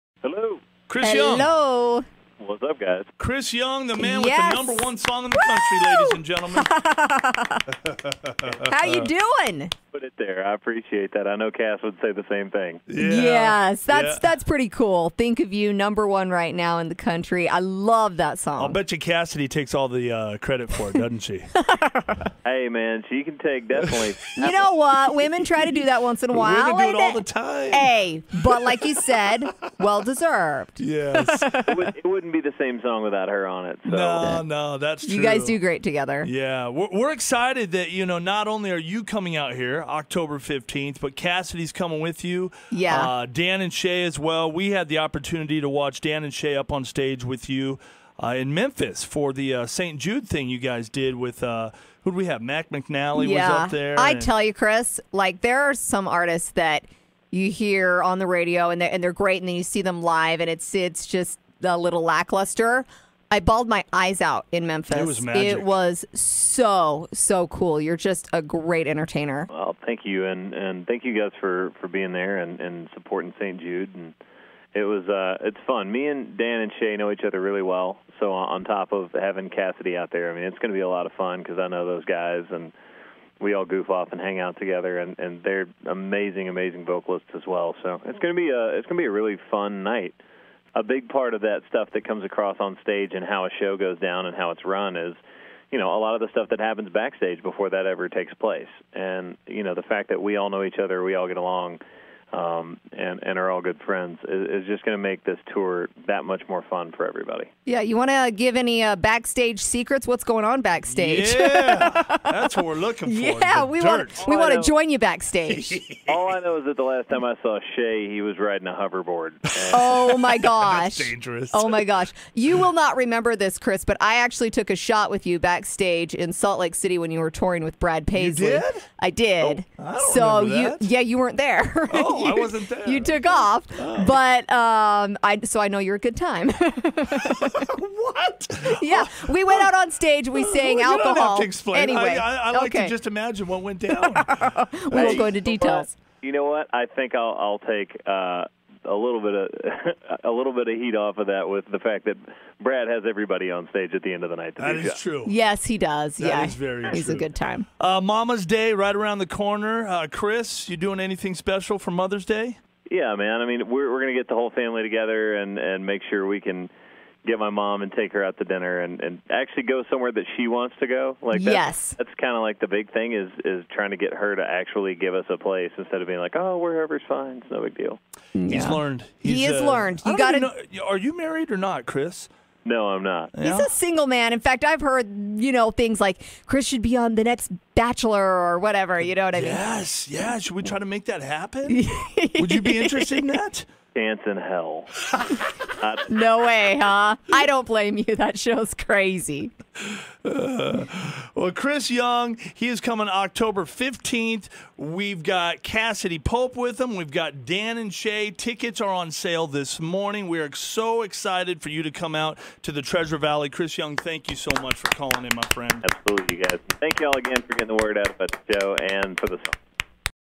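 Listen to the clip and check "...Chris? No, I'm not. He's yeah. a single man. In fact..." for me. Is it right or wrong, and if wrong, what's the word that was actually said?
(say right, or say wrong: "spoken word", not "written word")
right.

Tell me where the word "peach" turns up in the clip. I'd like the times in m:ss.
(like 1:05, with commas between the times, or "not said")
not said.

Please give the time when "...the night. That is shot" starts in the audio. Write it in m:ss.
2:34.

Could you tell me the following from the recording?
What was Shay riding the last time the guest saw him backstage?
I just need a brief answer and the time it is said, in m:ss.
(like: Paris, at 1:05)
A hoverboard, at 1:58.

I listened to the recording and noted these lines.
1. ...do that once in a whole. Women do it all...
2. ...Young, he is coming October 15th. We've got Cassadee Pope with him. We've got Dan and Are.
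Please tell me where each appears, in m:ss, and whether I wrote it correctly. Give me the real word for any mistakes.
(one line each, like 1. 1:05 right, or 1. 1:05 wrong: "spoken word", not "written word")
1. 0:25 wrong: "while", not "whole"
2. 3:21 wrong: "Shay", not "Are".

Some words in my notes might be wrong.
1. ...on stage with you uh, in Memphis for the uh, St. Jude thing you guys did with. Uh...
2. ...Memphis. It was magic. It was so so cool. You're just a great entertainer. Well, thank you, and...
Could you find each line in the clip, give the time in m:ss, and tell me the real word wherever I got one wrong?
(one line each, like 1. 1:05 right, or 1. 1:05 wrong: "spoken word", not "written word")
1. 0:46 right
2. 1:04 right.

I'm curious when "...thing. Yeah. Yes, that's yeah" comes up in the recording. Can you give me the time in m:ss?
0:12.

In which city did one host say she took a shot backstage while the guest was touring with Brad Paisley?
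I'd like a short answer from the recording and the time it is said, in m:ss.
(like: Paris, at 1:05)
Salt Lake City, at 2:06.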